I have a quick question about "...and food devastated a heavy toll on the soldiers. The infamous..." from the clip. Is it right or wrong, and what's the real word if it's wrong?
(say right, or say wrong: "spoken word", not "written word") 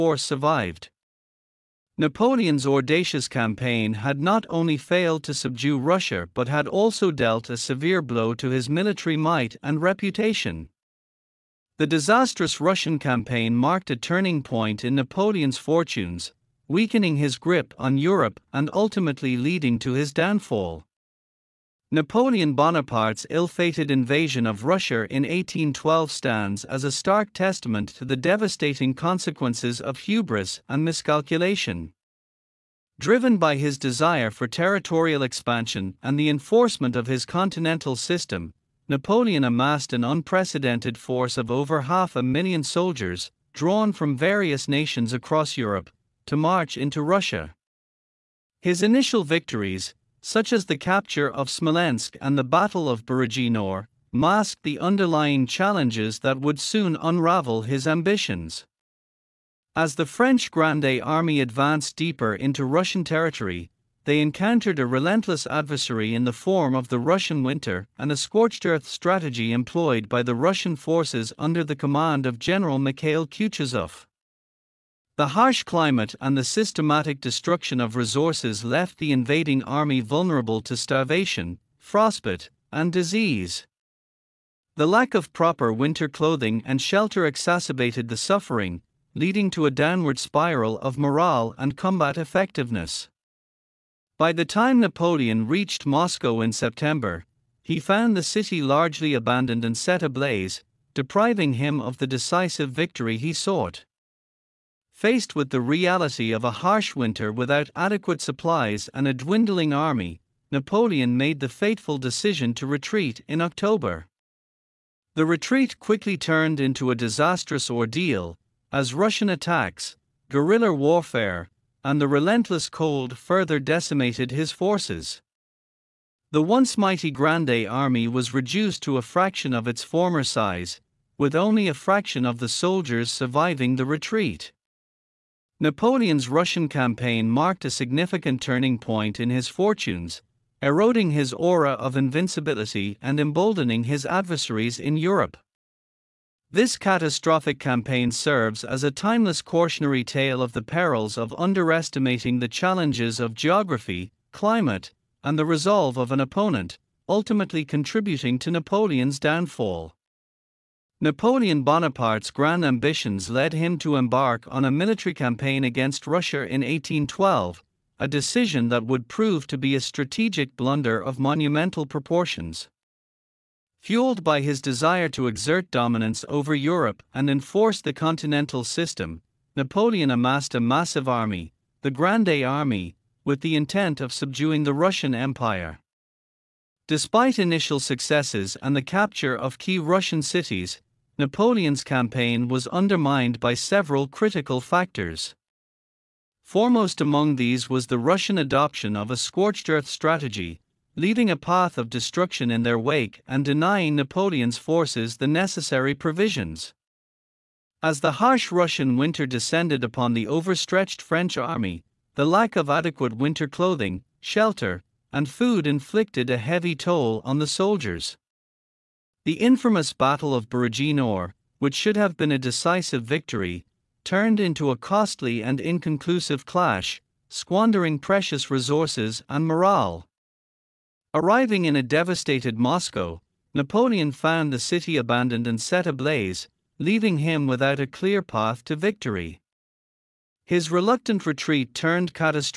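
wrong: "inflicted", not "devastated".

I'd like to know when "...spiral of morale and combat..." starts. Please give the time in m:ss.
1:30.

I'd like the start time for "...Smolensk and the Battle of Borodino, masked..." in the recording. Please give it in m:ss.
0:51.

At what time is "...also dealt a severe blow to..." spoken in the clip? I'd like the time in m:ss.
0:06.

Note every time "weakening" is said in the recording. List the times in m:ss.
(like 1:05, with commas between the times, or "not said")
0:16.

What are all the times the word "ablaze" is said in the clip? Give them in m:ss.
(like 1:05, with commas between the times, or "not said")
1:40, 3:55.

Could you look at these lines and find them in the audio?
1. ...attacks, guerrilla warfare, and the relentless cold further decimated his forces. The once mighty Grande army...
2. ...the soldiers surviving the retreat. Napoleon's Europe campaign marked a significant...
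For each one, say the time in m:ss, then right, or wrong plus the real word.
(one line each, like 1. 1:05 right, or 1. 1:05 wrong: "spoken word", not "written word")
1. 1:59 right
2. 2:12 wrong: "Russian", not "Europe".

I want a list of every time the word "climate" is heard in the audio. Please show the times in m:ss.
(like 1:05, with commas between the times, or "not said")
1:15, 2:34.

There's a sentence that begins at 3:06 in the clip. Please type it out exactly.
Despite initial successes and the capture of key Russian cities, Napoleon's campaign was undermined by several critical factors.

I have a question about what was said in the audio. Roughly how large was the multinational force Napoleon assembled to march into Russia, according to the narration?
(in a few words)
over half a million soldiers.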